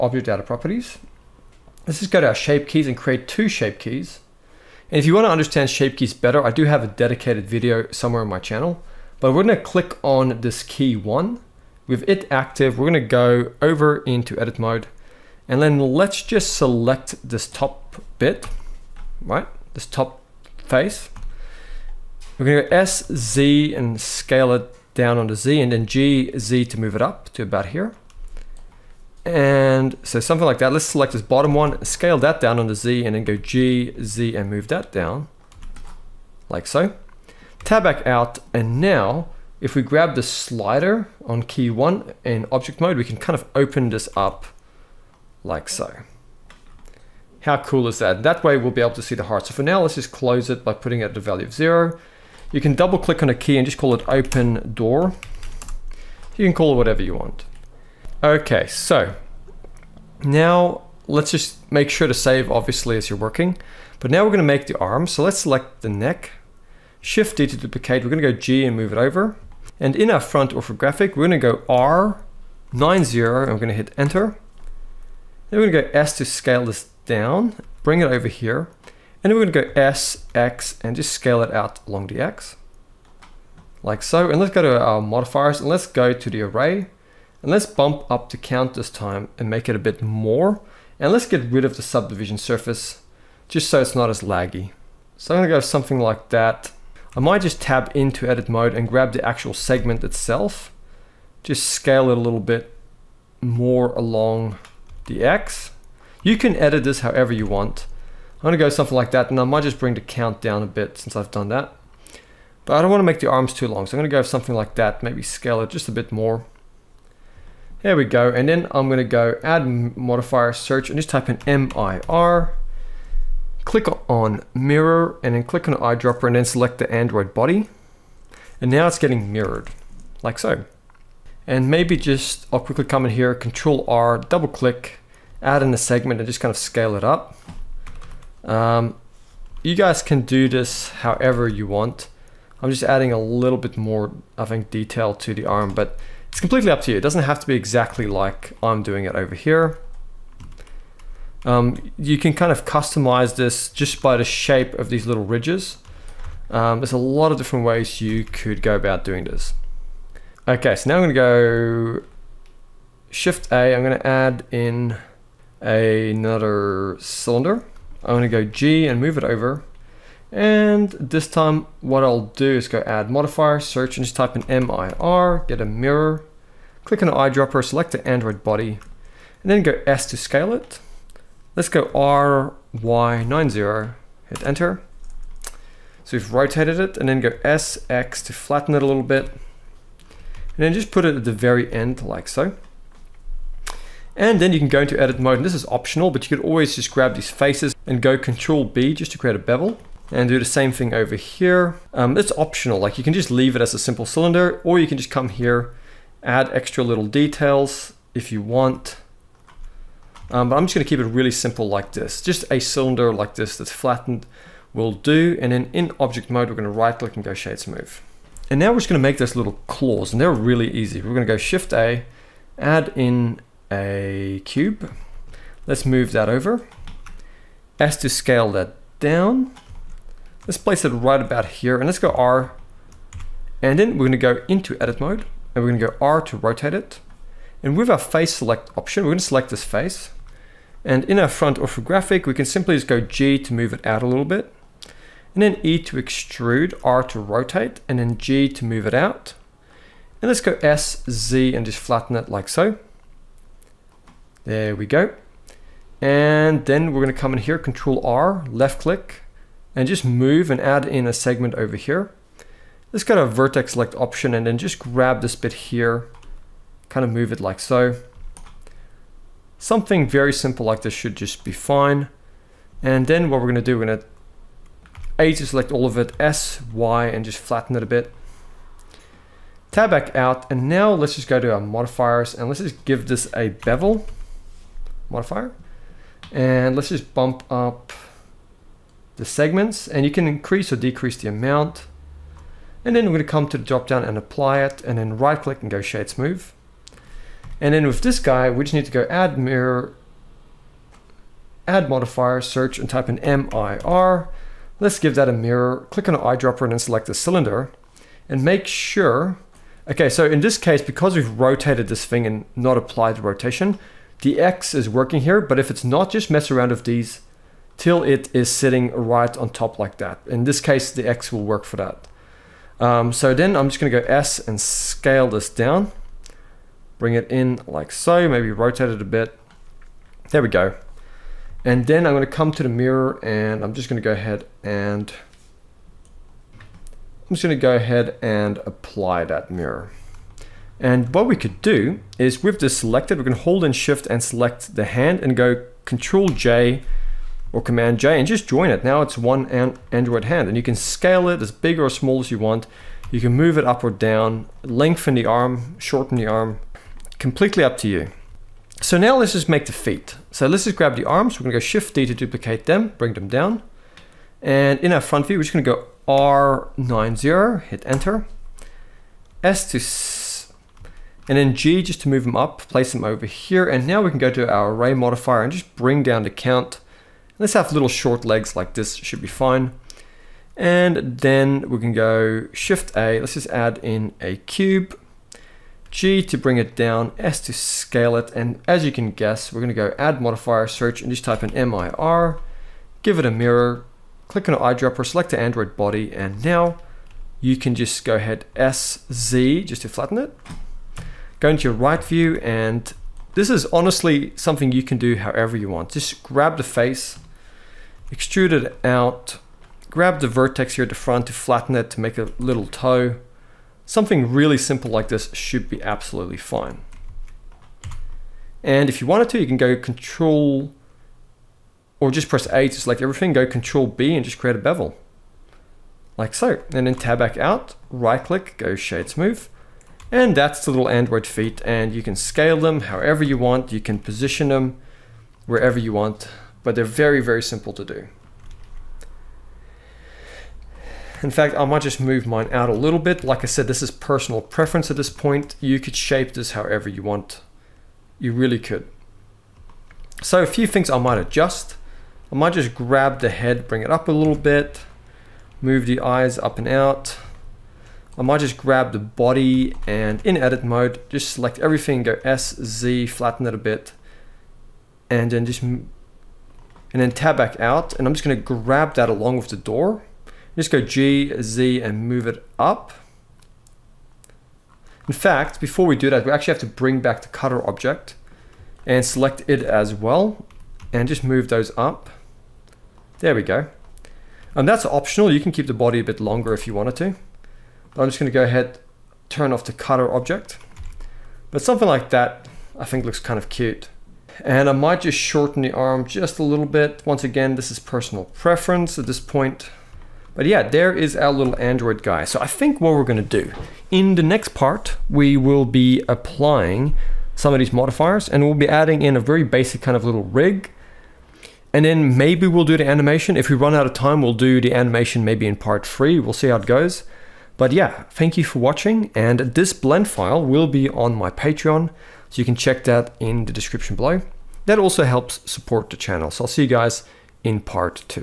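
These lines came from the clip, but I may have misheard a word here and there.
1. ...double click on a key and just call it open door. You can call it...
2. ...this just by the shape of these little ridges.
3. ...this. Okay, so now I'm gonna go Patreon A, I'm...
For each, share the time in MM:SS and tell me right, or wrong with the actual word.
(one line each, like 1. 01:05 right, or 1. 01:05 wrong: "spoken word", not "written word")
1. 00:52 right
2. 02:33 right
3. 02:39 wrong: "Shift", not "Patreon".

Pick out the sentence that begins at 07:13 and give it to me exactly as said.
You can position them wherever you want, but they're very, very simple to do.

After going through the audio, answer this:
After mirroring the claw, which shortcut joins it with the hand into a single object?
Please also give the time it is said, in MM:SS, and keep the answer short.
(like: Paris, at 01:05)
control J, at 05:45.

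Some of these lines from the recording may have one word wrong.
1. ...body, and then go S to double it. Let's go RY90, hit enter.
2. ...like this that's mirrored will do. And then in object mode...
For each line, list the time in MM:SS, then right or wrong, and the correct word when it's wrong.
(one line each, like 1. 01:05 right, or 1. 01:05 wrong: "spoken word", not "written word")
1. 02:58 wrong: "scale", not "double"
2. 03:33 wrong: "flattened", not "mirrored".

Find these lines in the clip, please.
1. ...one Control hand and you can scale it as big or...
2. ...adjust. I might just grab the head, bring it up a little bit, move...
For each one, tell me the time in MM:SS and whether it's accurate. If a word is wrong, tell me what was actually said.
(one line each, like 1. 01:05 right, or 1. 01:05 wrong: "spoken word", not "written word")
1. 05:49 wrong: "Android", not "Control"
2. 07:31 right.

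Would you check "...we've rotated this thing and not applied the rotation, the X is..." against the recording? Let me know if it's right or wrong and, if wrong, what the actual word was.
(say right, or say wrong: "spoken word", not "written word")
right.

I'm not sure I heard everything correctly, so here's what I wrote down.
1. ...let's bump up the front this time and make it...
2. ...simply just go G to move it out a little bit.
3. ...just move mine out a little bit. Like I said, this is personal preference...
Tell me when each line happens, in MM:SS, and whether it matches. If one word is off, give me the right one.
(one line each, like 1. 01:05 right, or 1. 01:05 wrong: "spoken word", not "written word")
1. 01:27 wrong: "count", not "front"
2. 04:02 right
3. 07:21 right.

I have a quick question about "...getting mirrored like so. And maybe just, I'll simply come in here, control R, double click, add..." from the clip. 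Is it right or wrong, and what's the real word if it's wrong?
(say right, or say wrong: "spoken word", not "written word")
wrong: "quickly", not "simply".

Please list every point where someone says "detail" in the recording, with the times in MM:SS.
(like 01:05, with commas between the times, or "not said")
02:24, 03:27.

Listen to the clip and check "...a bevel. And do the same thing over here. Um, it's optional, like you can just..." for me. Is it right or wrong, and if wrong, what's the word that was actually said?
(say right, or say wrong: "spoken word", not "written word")
right.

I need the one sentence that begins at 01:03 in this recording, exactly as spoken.
But now we're gonna make the arm.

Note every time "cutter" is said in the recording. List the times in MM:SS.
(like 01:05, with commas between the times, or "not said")
07:57, 08:09.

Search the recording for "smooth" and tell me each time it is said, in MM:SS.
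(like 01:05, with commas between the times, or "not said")
03:37, 04:56, 07:09.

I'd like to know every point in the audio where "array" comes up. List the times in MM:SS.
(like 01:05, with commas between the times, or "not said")
01:26, 06:14.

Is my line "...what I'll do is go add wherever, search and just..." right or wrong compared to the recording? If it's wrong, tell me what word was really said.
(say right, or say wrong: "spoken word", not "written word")
wrong: "modifier", not "wherever".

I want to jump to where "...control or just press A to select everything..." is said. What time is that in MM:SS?
06:59.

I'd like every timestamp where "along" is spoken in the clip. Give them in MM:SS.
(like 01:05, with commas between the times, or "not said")
01:21, 01:43, 07:49.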